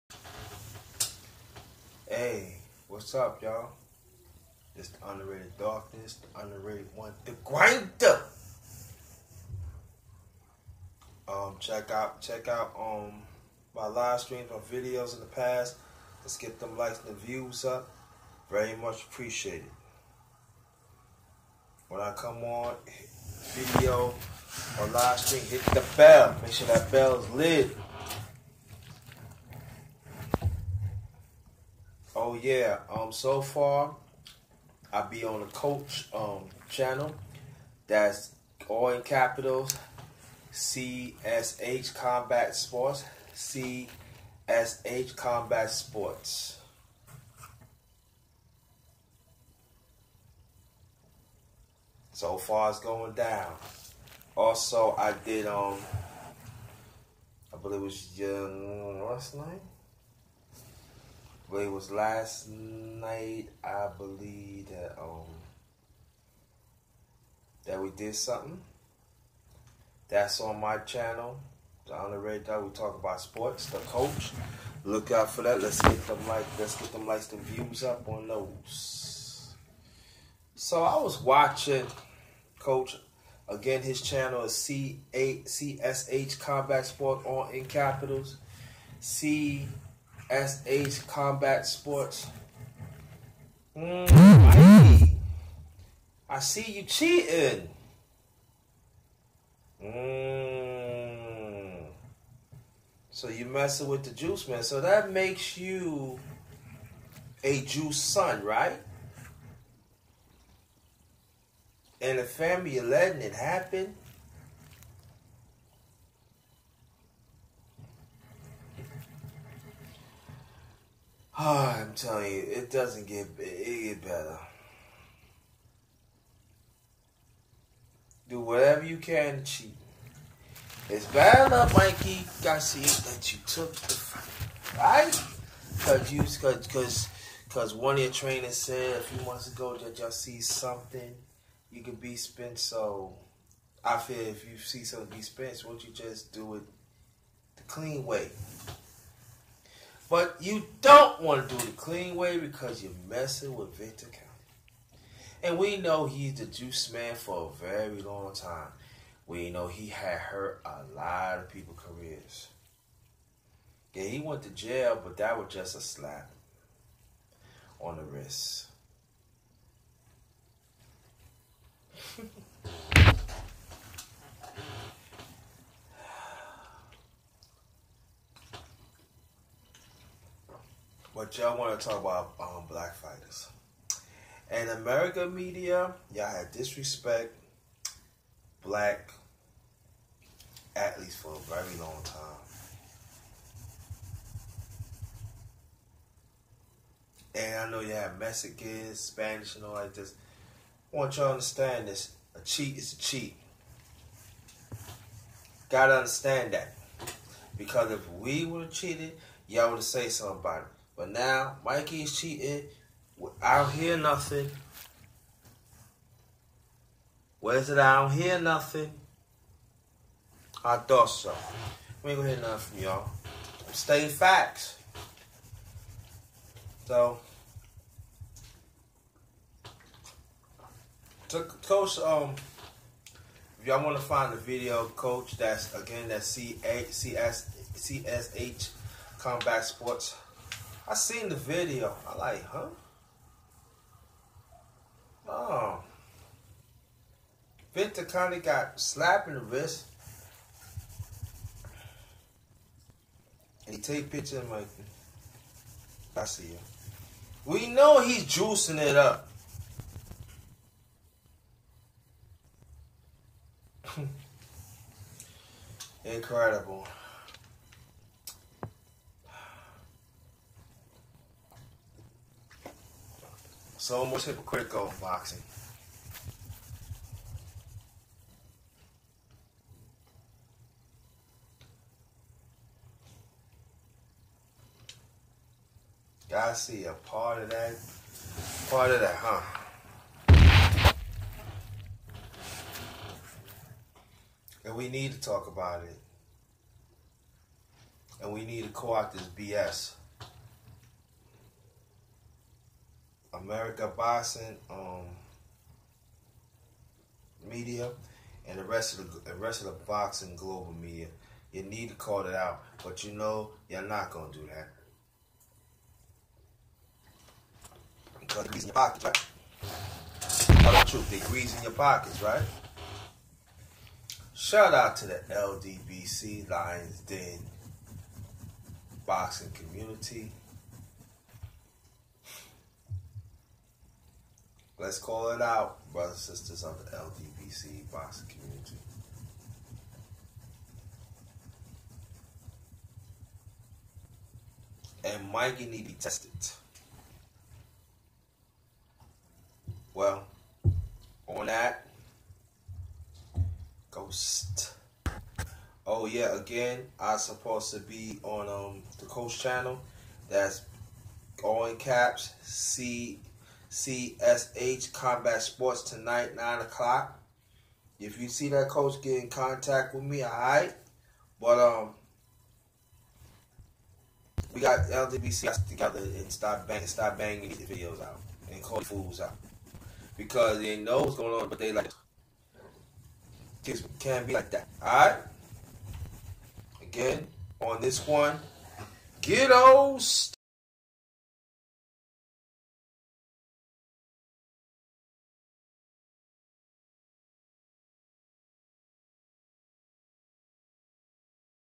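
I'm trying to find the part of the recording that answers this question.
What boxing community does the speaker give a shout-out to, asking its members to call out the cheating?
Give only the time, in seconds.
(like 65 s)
326 s.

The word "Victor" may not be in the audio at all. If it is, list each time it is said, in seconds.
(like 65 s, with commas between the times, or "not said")
153 s, 247 s.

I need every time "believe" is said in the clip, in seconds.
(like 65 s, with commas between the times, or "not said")
57 s, 63 s.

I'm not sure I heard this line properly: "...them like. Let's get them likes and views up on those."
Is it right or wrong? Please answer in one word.
right.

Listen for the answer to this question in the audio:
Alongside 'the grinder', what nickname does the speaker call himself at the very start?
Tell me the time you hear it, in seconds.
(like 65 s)
4 s.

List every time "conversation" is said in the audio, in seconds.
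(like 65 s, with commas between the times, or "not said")
not said.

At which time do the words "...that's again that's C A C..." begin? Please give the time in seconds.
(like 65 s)
235 s.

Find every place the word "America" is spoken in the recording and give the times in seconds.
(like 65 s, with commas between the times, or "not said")
184 s, 303 s.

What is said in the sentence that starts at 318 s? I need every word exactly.
Because it's in your pockets, right?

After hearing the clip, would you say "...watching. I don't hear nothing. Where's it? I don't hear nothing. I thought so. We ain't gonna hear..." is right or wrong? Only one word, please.
wrong.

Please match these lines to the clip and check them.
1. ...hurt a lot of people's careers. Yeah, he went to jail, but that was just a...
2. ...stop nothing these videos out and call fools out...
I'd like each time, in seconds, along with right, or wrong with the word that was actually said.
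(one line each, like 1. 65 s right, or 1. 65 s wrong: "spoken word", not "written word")
1. 160 s right
2. 376 s wrong: "banging", not "nothing".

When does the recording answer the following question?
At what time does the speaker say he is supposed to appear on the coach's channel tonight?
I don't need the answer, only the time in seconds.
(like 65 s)
366 s.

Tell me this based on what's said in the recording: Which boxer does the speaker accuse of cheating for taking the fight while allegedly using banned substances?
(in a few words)
Mikey Garcia.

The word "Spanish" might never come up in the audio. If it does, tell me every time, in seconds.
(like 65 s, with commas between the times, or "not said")
199 s.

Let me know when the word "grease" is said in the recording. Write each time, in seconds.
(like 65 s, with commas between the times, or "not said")
321 s.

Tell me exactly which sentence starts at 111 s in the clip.
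And the family are letting it happen.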